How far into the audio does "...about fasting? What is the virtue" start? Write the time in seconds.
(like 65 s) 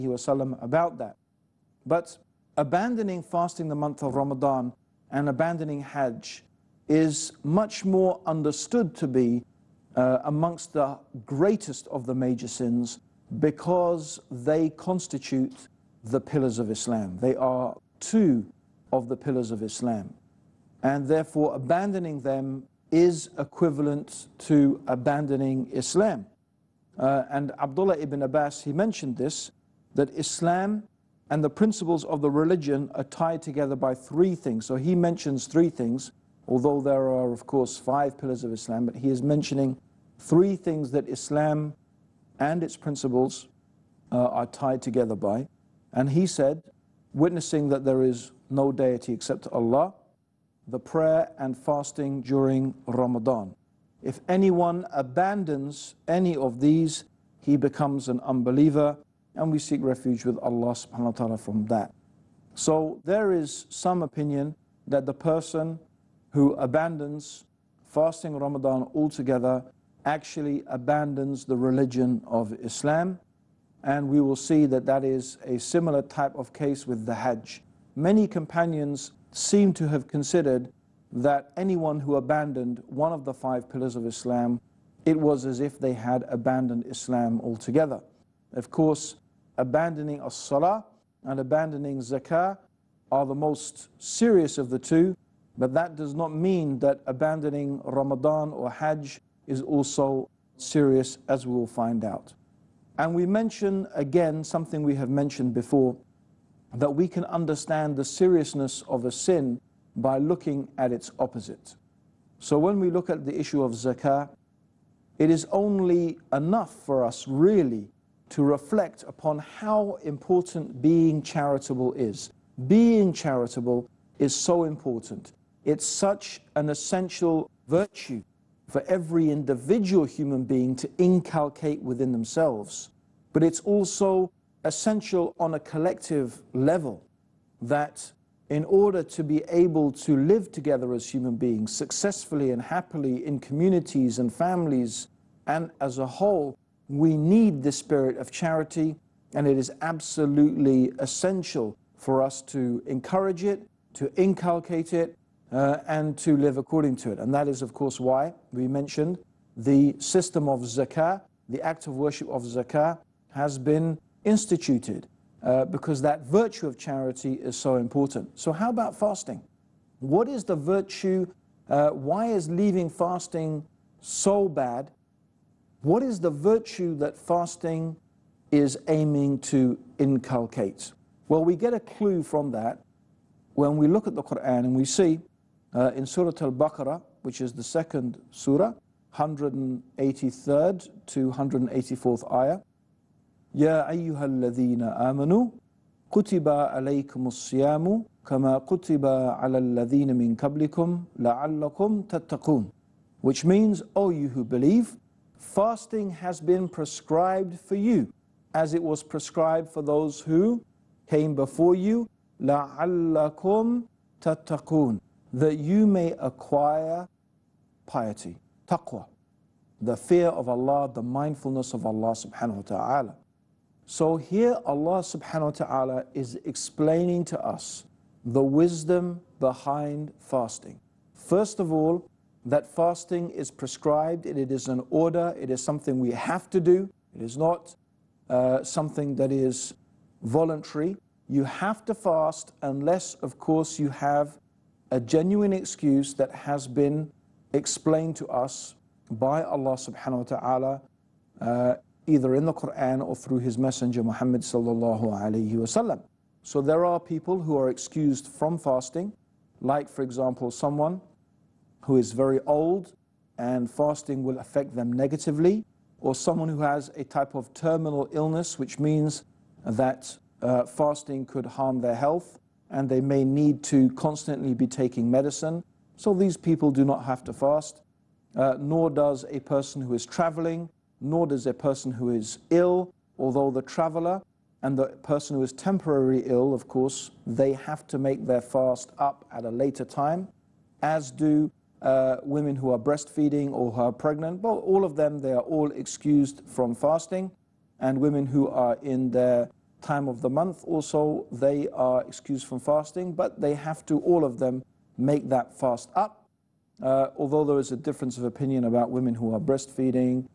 168 s.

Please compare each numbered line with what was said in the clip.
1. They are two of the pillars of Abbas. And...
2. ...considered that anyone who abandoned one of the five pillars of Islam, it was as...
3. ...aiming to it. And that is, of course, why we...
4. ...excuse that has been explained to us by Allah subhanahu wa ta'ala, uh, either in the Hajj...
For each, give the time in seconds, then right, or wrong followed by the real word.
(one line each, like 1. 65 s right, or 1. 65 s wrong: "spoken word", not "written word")
1. 17 s wrong: "Islam", not "Abbas"
2. 80 s right
3. 156 s wrong: "according", not "aiming"
4. 245 s wrong: "Quran", not "Hajj".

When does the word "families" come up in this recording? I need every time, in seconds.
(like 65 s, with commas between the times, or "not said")
144 s.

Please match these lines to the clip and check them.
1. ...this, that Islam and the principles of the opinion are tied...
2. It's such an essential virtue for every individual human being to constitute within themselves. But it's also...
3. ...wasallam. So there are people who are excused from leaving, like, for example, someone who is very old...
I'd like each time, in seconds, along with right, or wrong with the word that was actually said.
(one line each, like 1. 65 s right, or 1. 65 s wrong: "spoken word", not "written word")
1. 29 s wrong: "religion", not "opinion"
2. 125 s wrong: "inculcate", not "constitute"
3. 255 s wrong: "fasting", not "leaving".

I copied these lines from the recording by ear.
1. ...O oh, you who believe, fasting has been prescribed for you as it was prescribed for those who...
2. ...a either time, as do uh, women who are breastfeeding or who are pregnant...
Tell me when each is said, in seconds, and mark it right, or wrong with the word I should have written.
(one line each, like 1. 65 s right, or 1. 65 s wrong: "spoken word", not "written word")
1. 203 s right
2. 289 s wrong: "later", not "either".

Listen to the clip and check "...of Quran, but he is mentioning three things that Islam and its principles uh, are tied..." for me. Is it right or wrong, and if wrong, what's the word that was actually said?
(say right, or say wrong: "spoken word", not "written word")
wrong: "Islam", not "Quran".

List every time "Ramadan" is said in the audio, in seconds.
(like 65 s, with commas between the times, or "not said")
4 s, 52 s, 68 s, 97 s.